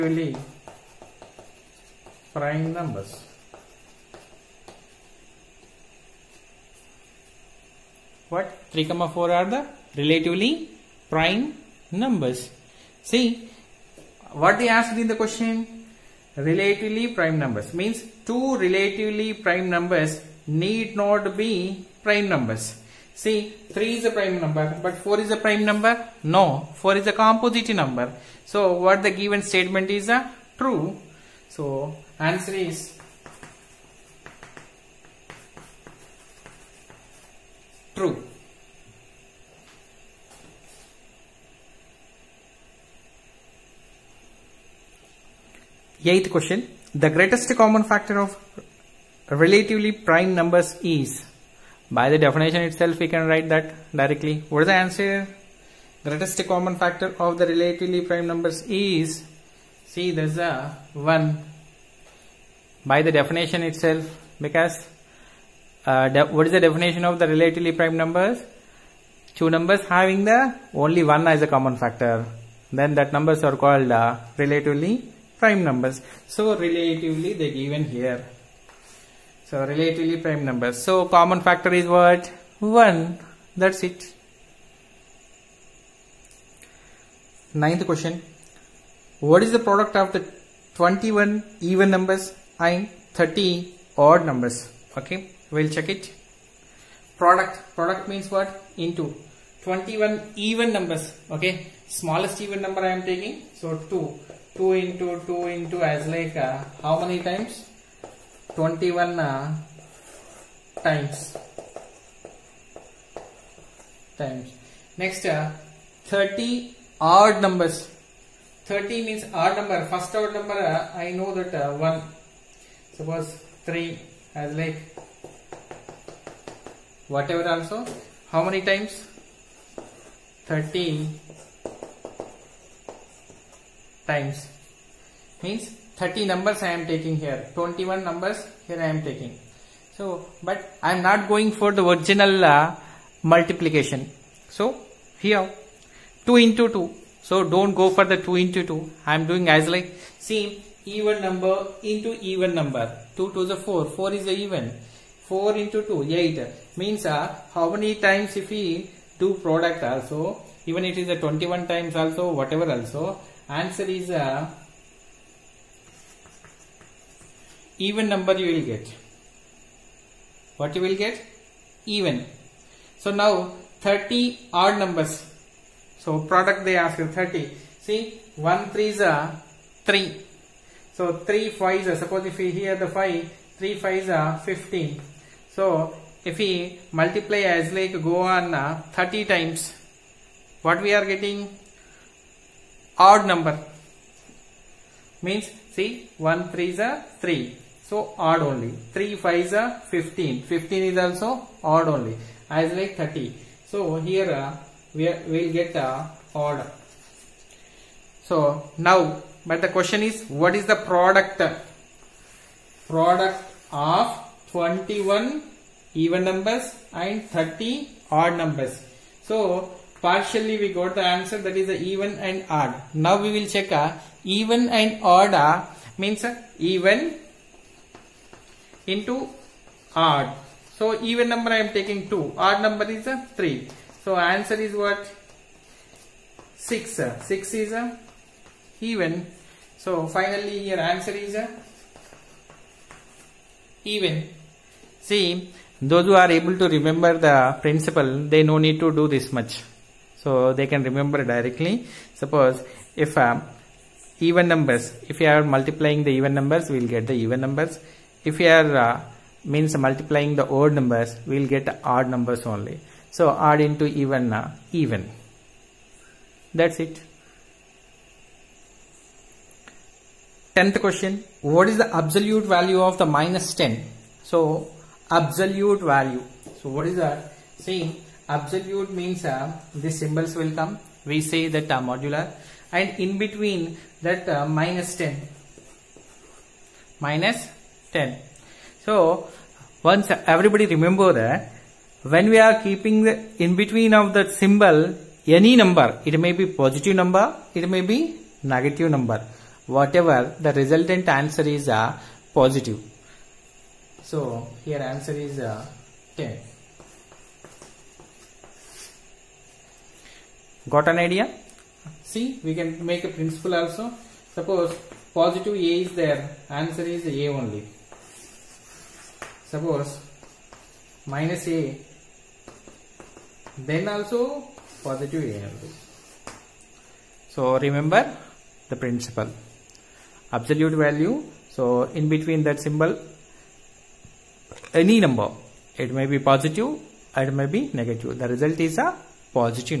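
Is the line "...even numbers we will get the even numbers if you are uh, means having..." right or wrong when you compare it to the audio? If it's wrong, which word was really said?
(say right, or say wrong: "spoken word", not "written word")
wrong: "multiplying", not "having".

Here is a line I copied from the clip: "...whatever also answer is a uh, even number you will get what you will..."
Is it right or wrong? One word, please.
right.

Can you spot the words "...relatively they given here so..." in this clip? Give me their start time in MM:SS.
01:16.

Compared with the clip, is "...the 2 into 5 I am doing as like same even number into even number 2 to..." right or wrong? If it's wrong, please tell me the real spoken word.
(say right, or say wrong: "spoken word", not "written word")
wrong: "2", not "5".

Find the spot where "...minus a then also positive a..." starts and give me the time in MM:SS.
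05:21.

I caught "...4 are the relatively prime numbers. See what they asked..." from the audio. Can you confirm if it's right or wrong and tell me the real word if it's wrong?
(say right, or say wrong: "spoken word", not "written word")
right.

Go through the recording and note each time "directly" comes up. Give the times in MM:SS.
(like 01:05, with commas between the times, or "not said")
00:53, 04:11.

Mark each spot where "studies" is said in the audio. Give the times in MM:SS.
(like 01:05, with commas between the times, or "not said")
not said.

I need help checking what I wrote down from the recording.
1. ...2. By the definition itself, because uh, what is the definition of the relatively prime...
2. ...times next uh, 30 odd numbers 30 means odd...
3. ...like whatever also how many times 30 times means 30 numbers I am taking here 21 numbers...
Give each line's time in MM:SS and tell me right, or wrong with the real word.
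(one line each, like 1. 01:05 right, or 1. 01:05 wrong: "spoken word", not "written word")
1. 01:00 wrong: "1", not "2"
2. 01:54 right
3. 02:04 right.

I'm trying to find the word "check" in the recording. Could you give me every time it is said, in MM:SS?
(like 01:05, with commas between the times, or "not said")
01:35, 03:43.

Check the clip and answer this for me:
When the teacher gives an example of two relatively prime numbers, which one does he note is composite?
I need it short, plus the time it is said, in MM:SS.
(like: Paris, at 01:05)
4, at 00:26.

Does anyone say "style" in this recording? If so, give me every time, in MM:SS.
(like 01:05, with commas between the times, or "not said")
not said.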